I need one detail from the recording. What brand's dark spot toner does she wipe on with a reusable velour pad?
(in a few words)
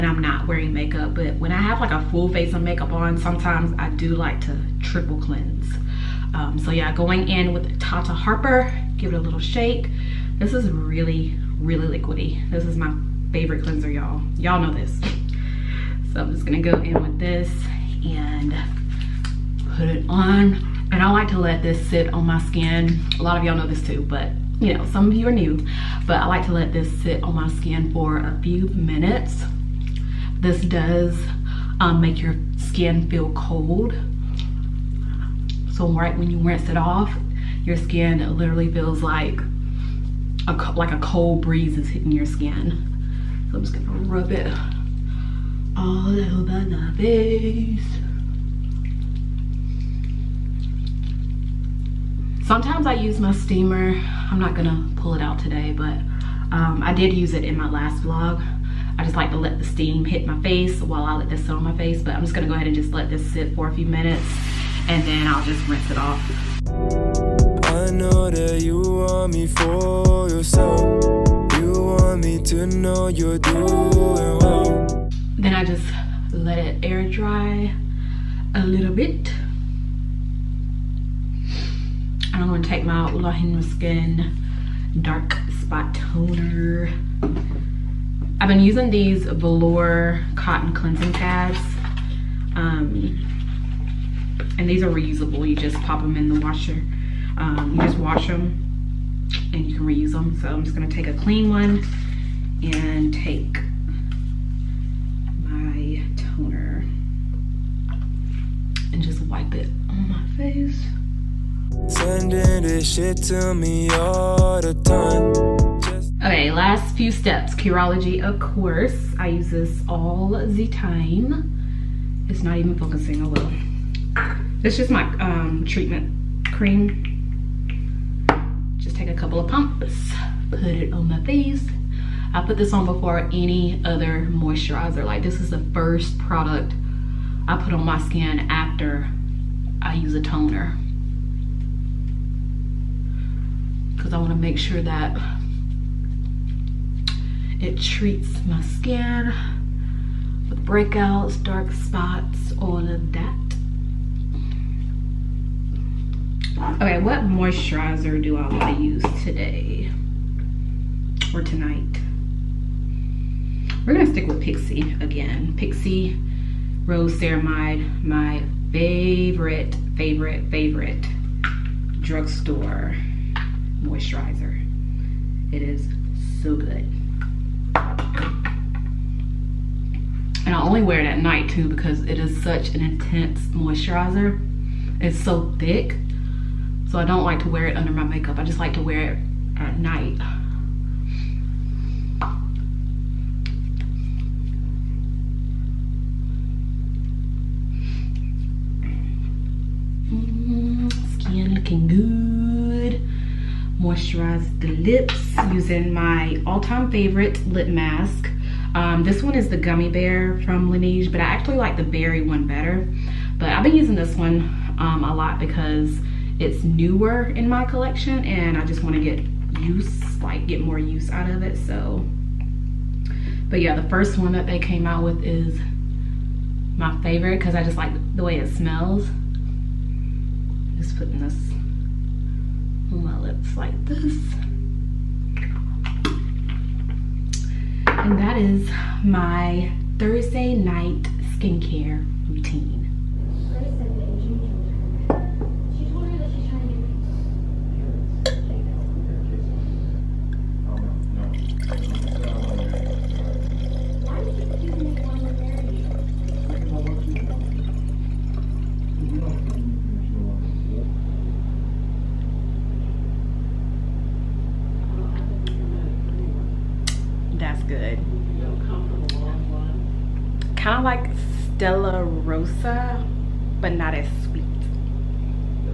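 Ole Henriksen.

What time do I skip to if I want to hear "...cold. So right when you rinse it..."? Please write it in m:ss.
0:33.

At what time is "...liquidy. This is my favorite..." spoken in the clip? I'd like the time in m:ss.
0:11.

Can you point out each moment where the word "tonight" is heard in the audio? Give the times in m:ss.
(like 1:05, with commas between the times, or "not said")
2:41.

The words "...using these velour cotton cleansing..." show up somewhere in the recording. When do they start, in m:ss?
1:28.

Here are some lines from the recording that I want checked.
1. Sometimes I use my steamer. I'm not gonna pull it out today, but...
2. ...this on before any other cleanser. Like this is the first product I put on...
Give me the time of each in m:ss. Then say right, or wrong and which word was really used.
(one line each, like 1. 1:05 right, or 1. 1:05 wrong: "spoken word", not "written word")
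1. 0:52 right
2. 2:12 wrong: "moisturizer", not "cleanser".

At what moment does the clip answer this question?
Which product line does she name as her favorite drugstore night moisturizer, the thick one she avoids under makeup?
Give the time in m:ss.
2:45.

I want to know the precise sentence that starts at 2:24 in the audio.
because I want to make sure that it treats my skin with breakouts, dark spots, all of that.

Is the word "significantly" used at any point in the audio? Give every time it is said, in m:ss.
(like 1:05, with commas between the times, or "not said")
not said.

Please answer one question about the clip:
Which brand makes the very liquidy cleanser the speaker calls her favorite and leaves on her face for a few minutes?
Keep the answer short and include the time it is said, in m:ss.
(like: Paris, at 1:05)
Tata Harper, at 0:07.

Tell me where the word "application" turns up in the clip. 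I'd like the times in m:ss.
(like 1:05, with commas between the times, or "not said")
not said.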